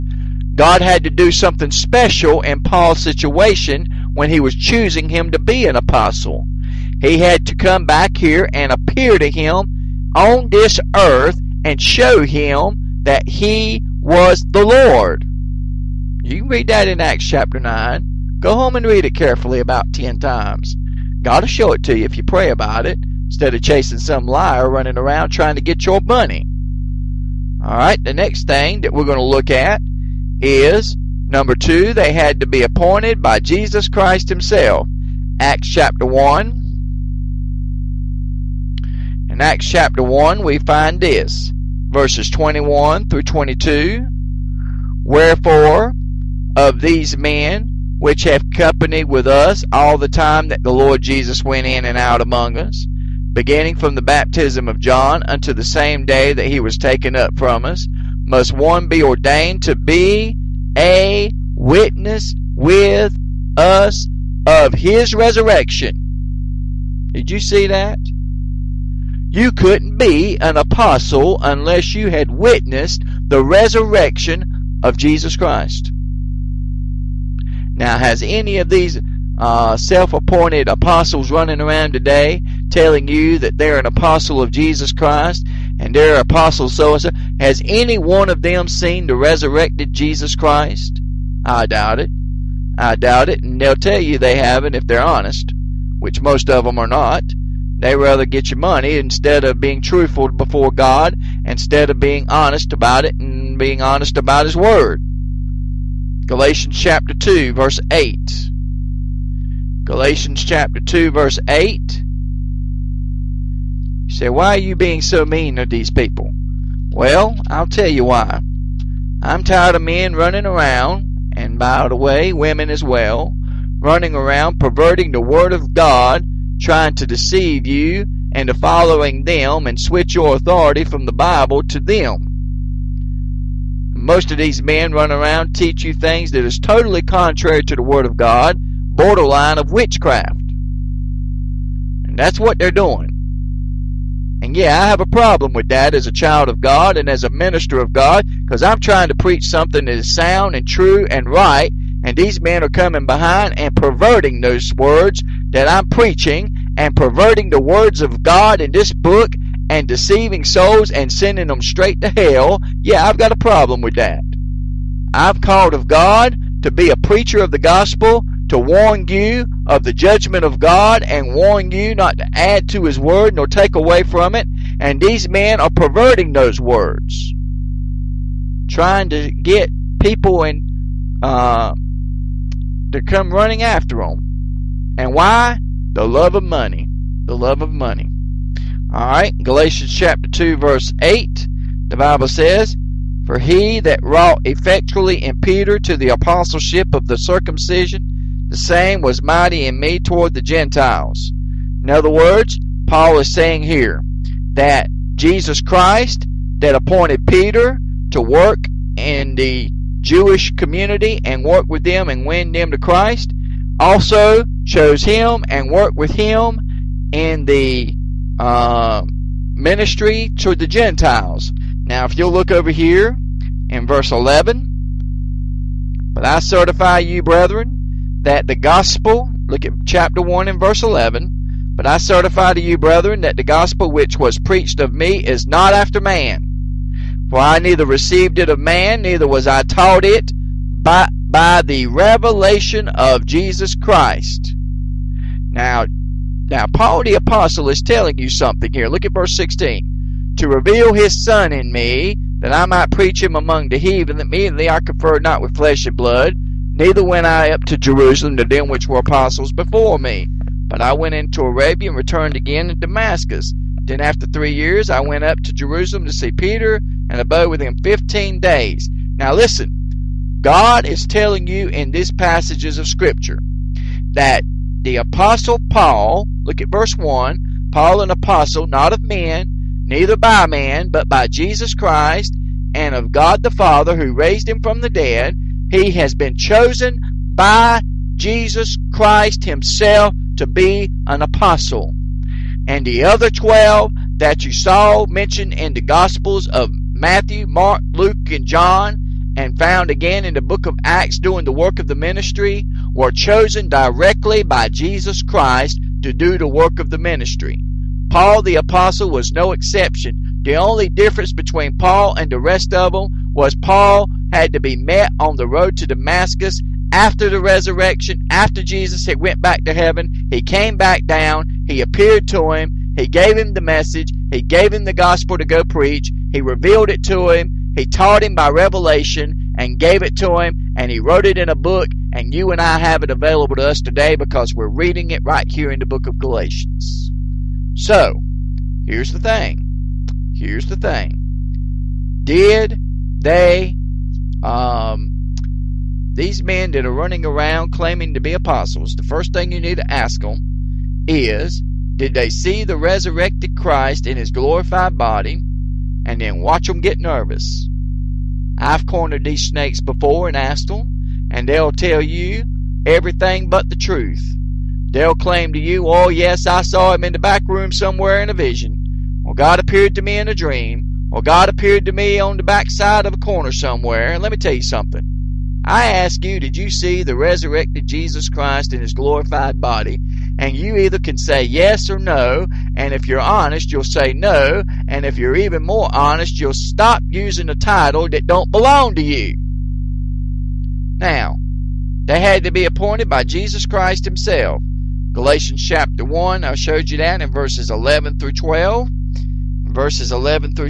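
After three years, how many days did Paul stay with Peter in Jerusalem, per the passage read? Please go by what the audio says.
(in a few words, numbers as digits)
15.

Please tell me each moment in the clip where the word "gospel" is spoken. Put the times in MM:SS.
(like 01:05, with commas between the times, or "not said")
02:47, 03:48, 03:53, 04:55, 05:24.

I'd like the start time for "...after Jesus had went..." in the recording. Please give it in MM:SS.
05:18.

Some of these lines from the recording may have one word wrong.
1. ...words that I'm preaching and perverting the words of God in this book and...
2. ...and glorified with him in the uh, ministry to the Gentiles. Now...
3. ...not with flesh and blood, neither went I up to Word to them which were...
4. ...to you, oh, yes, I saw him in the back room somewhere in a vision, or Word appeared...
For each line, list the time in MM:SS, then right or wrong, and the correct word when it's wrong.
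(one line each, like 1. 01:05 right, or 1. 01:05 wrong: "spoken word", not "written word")
1. 02:34 right
2. 03:35 wrong: "worked", not "glorified"
3. 04:15 wrong: "Jerusalem", not "Word"
4. 06:05 wrong: "God", not "Word".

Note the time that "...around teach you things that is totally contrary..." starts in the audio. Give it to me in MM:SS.
02:15.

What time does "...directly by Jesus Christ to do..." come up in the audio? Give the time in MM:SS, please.
05:03.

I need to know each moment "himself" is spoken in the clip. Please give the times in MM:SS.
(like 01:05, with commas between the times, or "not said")
00:34, 04:49, 06:34.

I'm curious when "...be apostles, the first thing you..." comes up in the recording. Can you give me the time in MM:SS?
05:48.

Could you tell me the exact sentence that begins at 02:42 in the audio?
Yeah, I've got a problem with that.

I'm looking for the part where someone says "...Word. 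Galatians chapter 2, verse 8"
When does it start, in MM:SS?
01:44.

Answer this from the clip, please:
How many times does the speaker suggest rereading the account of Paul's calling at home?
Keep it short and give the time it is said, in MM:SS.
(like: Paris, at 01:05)
10, at 00:19.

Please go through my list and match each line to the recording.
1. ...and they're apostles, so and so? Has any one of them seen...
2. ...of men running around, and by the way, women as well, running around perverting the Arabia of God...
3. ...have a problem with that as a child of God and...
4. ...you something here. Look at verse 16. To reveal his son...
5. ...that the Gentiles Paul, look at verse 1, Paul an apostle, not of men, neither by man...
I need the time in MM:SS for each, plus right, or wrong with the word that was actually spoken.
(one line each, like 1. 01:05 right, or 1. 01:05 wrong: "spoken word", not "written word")
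1. 01:25 right
2. 01:59 wrong: "Word", not "Arabia"
3. 02:24 right
4. 04:08 right
5. 04:34 wrong: "Apostle", not "Gentiles".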